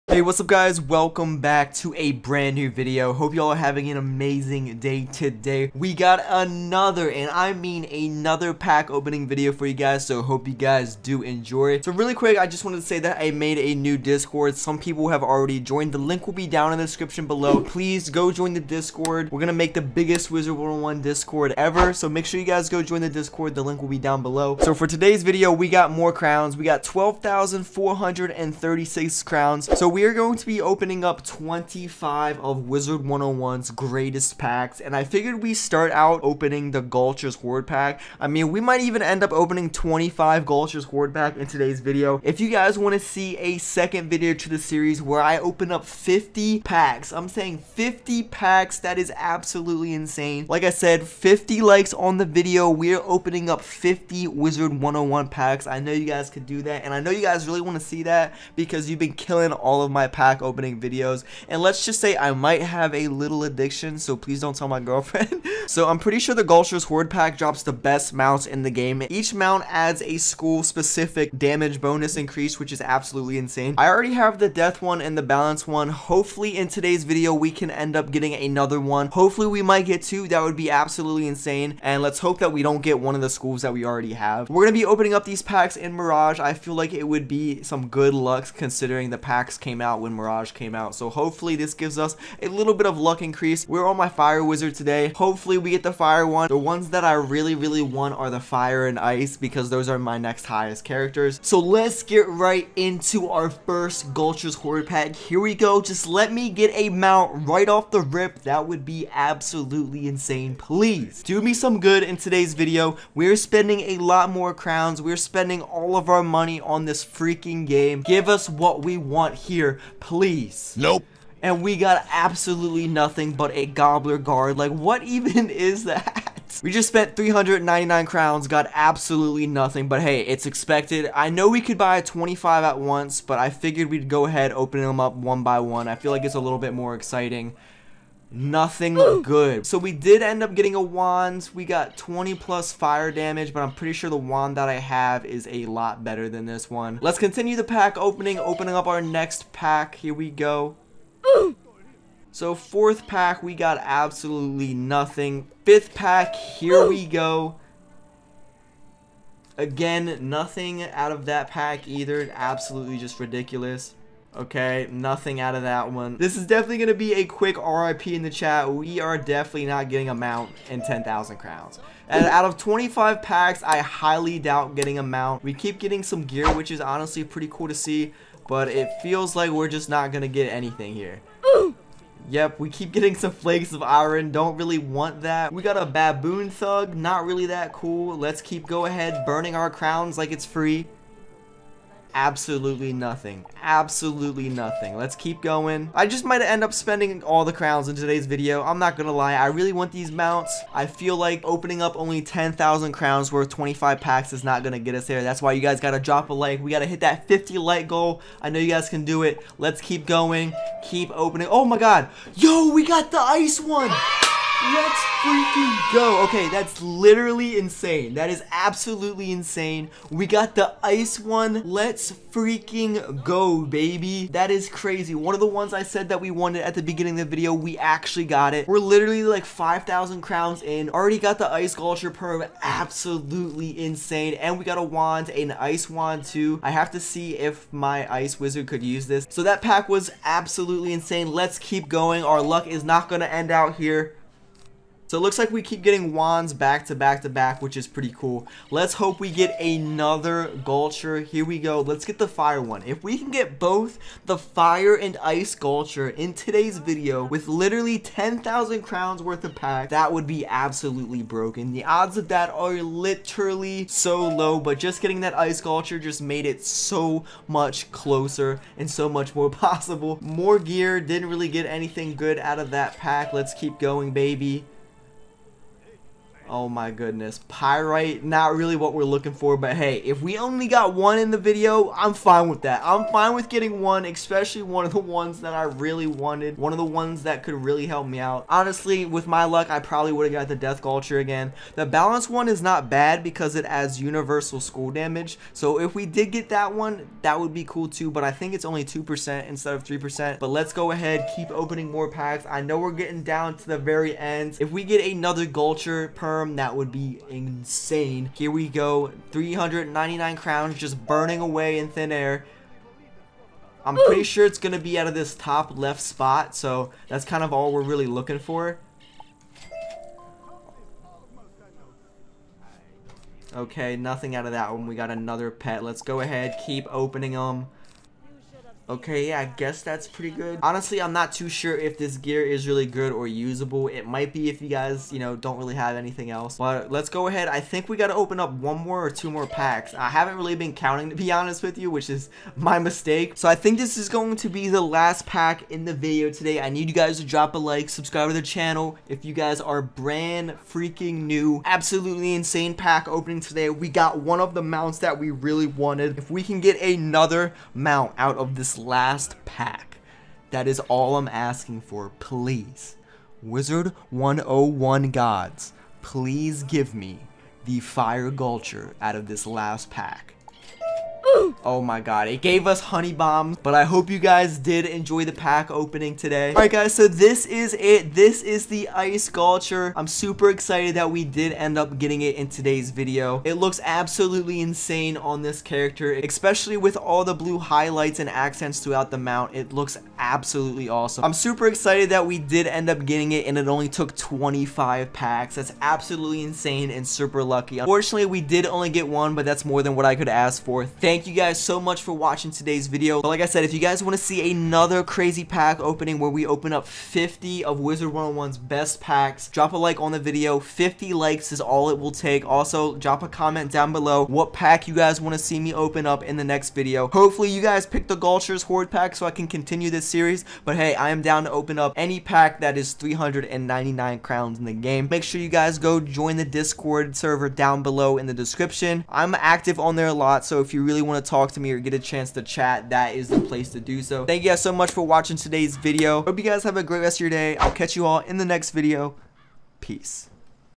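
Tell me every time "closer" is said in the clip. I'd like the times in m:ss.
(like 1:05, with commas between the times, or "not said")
4:27.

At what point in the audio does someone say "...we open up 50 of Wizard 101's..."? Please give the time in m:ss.
6:46.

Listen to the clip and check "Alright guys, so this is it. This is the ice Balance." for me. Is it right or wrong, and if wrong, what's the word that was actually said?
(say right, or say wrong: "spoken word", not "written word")
wrong: "Gulcher", not "Balance".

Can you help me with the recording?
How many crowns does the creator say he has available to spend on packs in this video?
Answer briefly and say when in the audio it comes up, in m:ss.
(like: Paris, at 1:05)
12,436, at 0:26.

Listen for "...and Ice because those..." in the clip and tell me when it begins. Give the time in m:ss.
1:38.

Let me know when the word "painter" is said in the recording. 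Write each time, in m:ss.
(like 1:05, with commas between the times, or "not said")
not said.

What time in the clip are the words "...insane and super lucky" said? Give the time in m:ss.
6:36.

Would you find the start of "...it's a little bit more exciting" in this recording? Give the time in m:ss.
2:16.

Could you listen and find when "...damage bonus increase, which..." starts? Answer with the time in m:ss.
1:11.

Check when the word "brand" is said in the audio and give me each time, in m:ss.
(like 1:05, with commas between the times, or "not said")
0:02, 5:49.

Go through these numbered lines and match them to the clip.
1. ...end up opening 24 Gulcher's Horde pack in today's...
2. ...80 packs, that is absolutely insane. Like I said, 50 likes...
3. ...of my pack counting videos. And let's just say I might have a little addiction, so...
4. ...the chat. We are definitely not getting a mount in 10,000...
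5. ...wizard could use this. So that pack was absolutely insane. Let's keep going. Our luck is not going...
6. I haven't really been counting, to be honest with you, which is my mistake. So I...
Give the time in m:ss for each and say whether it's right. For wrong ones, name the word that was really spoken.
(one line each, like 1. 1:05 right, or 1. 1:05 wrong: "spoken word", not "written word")
1. 0:39 wrong: "25", not "24"
2. 0:47 wrong: "50", not "80"
3. 0:59 wrong: "opening", not "counting"
4. 2:48 right
5. 3:58 right
6. 5:39 right.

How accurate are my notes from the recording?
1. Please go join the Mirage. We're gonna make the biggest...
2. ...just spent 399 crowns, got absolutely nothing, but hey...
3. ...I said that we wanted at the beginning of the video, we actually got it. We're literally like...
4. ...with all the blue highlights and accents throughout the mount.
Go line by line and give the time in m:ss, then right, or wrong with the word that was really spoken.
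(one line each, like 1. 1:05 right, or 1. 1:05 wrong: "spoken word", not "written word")
1. 0:17 wrong: "Discord", not "Mirage"
2. 2:06 right
3. 3:45 right
4. 6:26 right.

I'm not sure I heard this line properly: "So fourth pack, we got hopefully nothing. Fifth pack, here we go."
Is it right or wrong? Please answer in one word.
wrong.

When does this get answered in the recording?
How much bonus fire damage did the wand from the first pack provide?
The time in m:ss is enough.
2:21.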